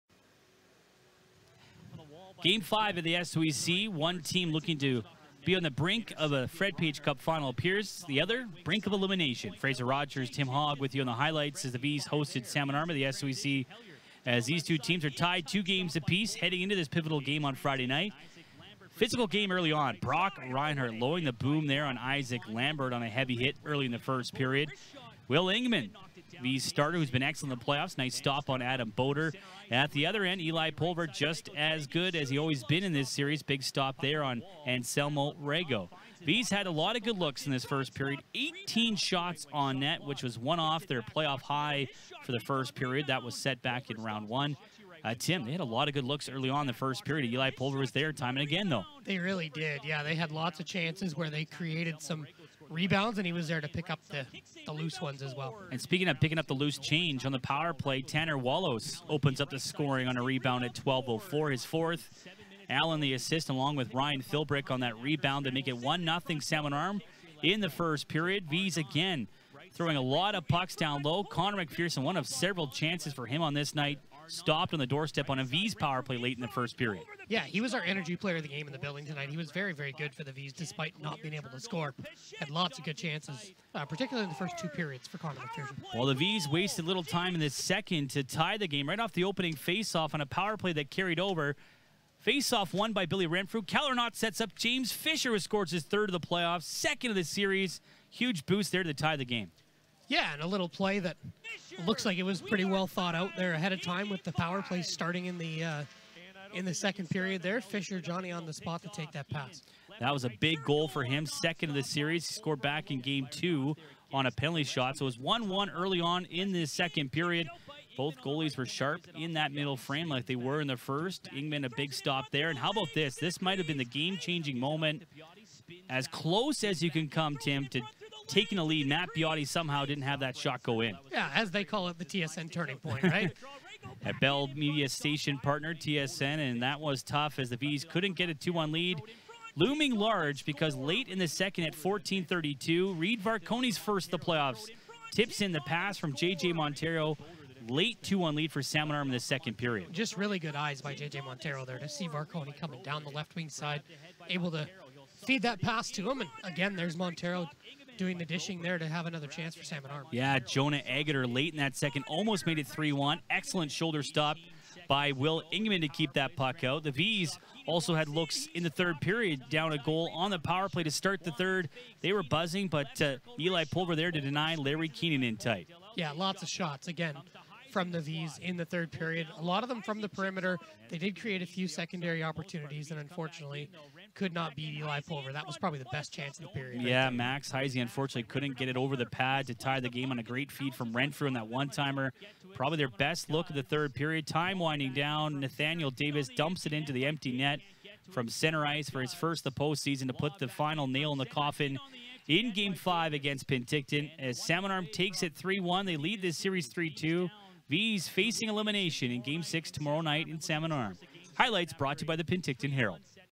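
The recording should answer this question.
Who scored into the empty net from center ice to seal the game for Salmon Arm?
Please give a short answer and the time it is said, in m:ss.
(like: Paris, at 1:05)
Nathaniel Davis, at 3:15.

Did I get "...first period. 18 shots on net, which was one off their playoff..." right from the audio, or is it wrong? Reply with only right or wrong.
right.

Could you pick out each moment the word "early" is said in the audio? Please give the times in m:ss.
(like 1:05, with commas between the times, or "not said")
0:19, 0:23, 0:46, 1:55.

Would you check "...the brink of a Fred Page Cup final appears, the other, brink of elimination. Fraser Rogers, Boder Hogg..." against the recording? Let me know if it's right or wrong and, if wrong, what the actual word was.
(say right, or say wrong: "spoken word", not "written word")
wrong: "Tim", not "Boder".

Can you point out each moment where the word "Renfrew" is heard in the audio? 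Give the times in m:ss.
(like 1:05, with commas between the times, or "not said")
1:33, 3:10.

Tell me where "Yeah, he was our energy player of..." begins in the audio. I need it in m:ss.
1:17.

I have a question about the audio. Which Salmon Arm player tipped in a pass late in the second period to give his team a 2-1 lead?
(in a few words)
Reed Varconi.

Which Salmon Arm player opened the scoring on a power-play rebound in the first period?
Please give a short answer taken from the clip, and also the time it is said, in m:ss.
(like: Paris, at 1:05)
Tanner Wallace, at 0:58.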